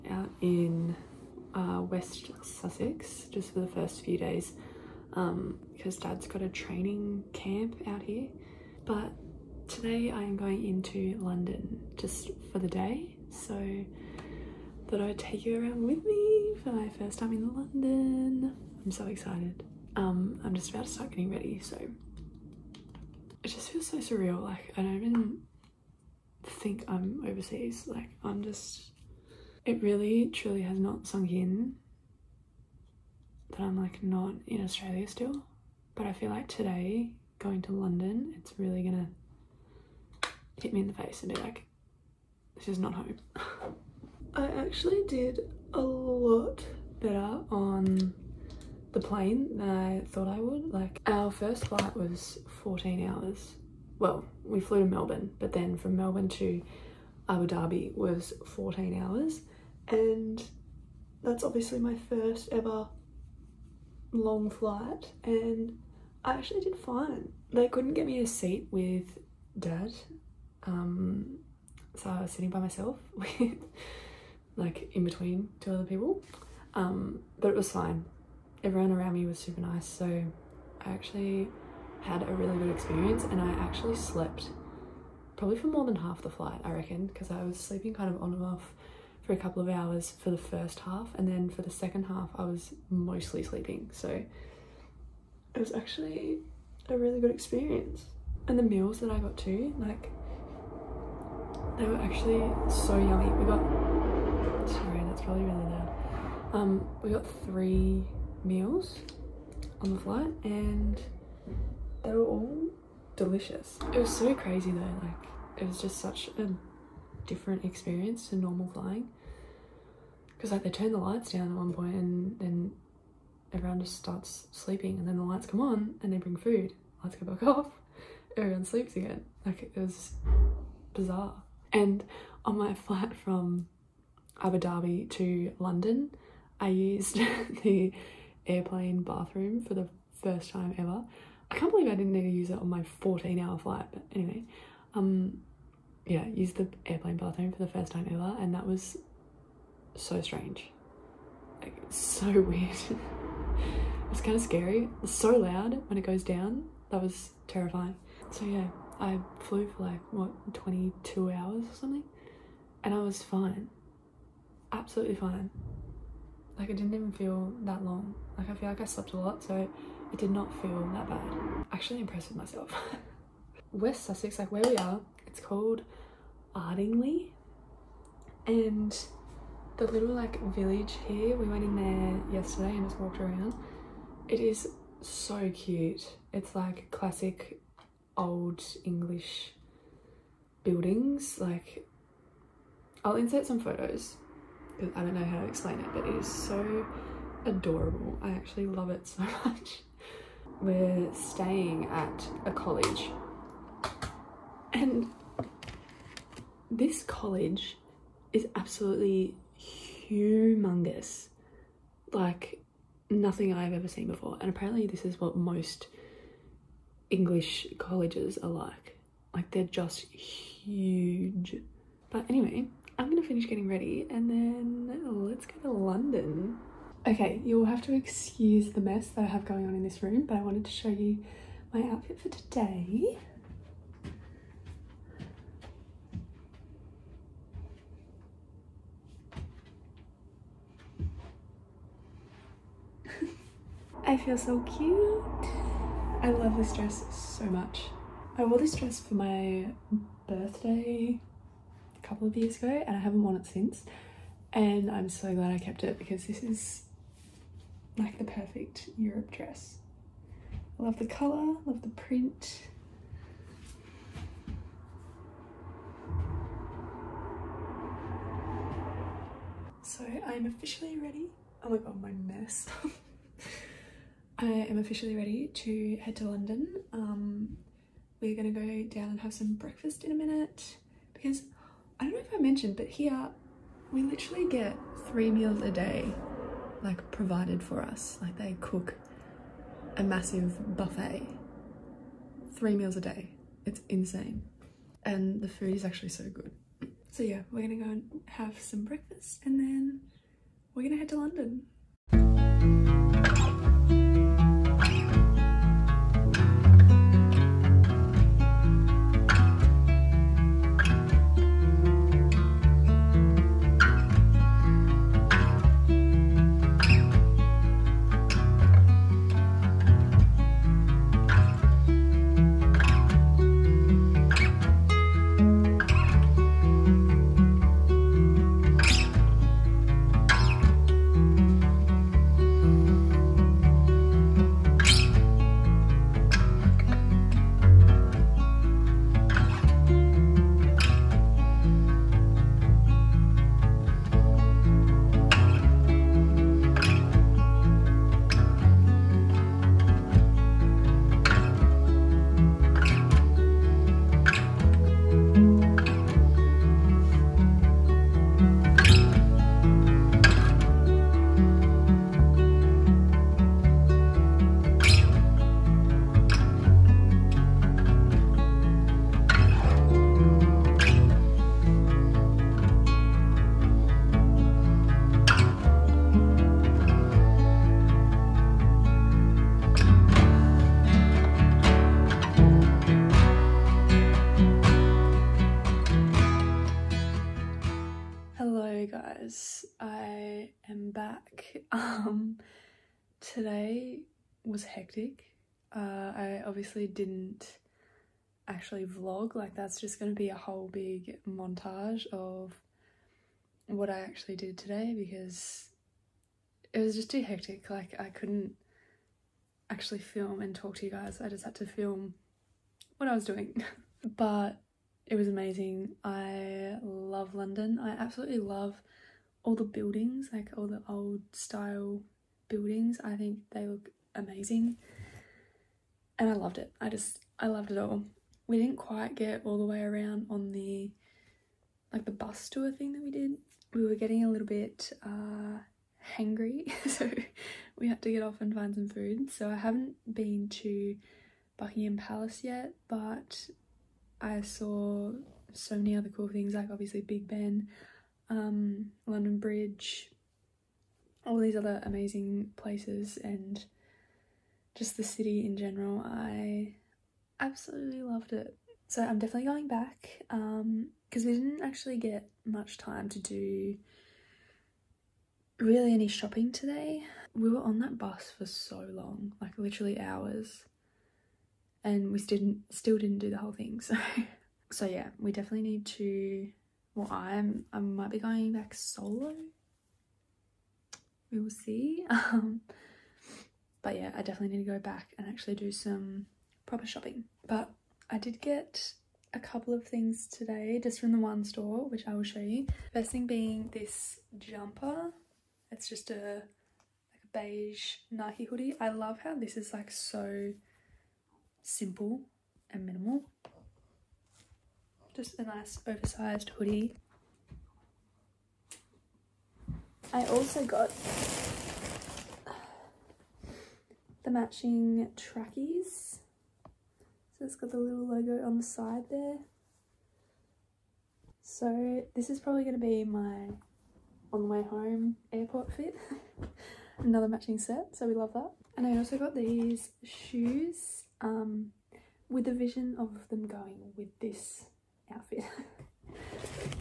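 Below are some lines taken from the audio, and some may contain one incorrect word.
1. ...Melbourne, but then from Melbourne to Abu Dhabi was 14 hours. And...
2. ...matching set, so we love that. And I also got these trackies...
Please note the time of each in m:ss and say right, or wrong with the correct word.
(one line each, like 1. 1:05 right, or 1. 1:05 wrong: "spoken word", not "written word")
1. 0:54 right
2. 8:47 wrong: "shoes", not "trackies".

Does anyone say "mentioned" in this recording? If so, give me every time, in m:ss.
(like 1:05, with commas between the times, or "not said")
4:42.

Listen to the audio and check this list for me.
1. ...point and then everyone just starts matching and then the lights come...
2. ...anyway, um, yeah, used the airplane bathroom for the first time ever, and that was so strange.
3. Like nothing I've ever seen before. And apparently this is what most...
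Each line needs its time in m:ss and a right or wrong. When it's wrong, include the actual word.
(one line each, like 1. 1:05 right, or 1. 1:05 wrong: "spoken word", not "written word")
1. 2:01 wrong: "sleeping", not "matching"
2. 2:24 right
3. 3:32 right.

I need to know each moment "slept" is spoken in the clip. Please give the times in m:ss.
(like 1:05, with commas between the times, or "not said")
1:23, 2:48.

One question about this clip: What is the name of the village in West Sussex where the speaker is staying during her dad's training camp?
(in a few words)
Ardingly.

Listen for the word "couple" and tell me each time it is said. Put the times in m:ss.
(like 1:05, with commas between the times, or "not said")
1:29, 4:12, 8:09.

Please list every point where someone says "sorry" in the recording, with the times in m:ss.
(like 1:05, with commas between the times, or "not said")
1:44.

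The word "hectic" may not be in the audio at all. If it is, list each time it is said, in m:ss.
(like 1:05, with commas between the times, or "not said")
6:34, 6:47.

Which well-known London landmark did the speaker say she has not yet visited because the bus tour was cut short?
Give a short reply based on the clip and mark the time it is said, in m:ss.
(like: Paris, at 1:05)
Buckingham Palace, at 7:21.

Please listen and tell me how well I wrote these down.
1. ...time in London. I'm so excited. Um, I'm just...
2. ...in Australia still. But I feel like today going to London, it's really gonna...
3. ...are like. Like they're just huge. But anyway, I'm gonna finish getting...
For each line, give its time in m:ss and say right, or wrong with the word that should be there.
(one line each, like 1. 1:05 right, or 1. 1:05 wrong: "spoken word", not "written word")
1. 0:17 right
2. 0:34 right
3. 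3:38 right.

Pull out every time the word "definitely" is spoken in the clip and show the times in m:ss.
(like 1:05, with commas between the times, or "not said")
7:39, 7:55, 8:04.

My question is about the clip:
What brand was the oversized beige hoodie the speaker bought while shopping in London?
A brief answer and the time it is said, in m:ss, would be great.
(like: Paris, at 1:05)
Nike, at 8:18.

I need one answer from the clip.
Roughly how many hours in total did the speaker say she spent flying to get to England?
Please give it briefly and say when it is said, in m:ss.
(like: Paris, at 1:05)
22, at 2:40.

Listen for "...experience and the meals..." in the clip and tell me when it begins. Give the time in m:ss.
1:37.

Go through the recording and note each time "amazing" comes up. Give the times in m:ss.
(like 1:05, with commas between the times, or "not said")
6:55, 7:04, 7:31.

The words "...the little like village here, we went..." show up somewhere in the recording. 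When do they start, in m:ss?
2:59.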